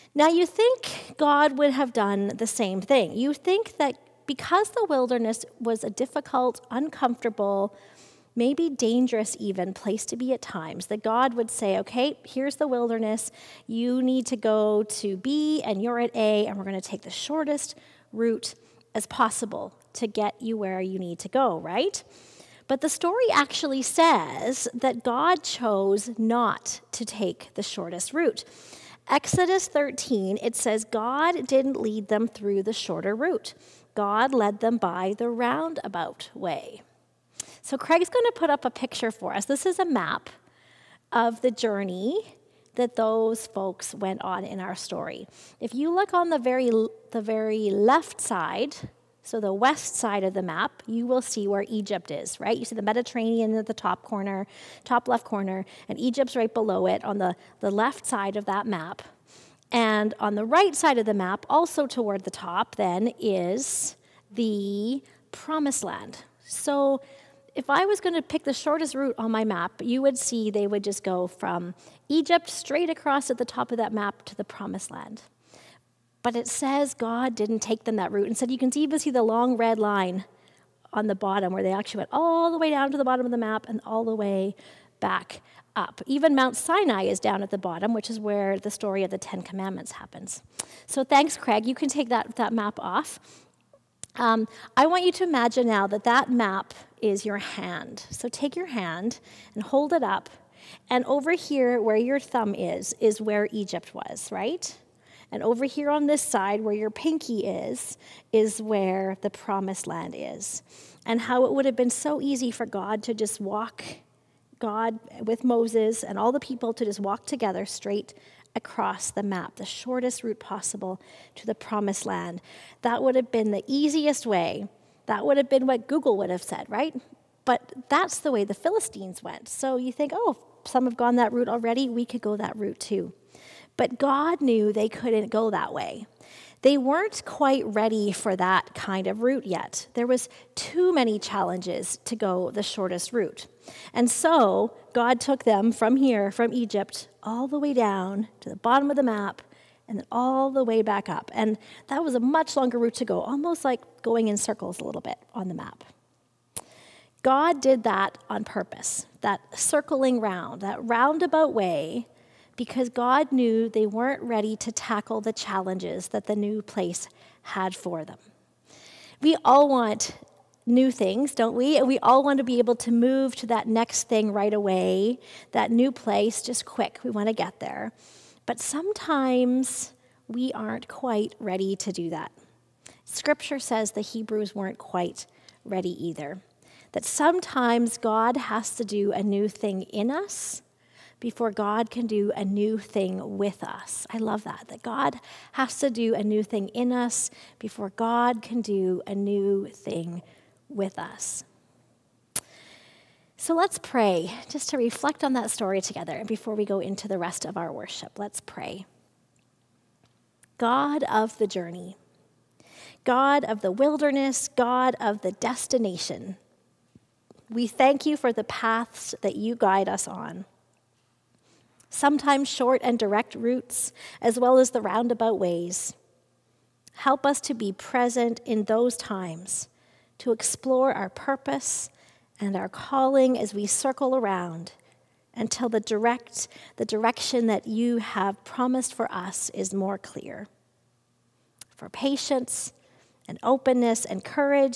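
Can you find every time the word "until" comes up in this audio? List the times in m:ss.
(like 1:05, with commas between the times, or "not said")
3:55.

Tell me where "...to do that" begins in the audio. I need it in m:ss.
3:01.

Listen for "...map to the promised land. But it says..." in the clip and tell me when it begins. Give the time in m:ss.
1:13.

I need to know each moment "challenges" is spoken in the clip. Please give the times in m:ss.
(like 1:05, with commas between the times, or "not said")
2:21, 2:45.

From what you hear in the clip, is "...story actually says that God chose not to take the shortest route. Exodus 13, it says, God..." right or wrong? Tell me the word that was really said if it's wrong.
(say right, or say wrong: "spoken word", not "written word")
right.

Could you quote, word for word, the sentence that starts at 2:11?
We could go that route too.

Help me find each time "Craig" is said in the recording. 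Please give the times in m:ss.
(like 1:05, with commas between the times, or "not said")
0:37, 1:31.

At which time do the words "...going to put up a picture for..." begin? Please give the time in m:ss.
0:38.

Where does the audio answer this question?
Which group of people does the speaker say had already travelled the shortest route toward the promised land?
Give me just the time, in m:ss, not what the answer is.
2:08.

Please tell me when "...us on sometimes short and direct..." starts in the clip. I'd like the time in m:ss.
3:39.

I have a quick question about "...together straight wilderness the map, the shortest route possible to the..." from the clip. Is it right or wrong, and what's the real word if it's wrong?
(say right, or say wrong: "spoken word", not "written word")
wrong: "across", not "wilderness".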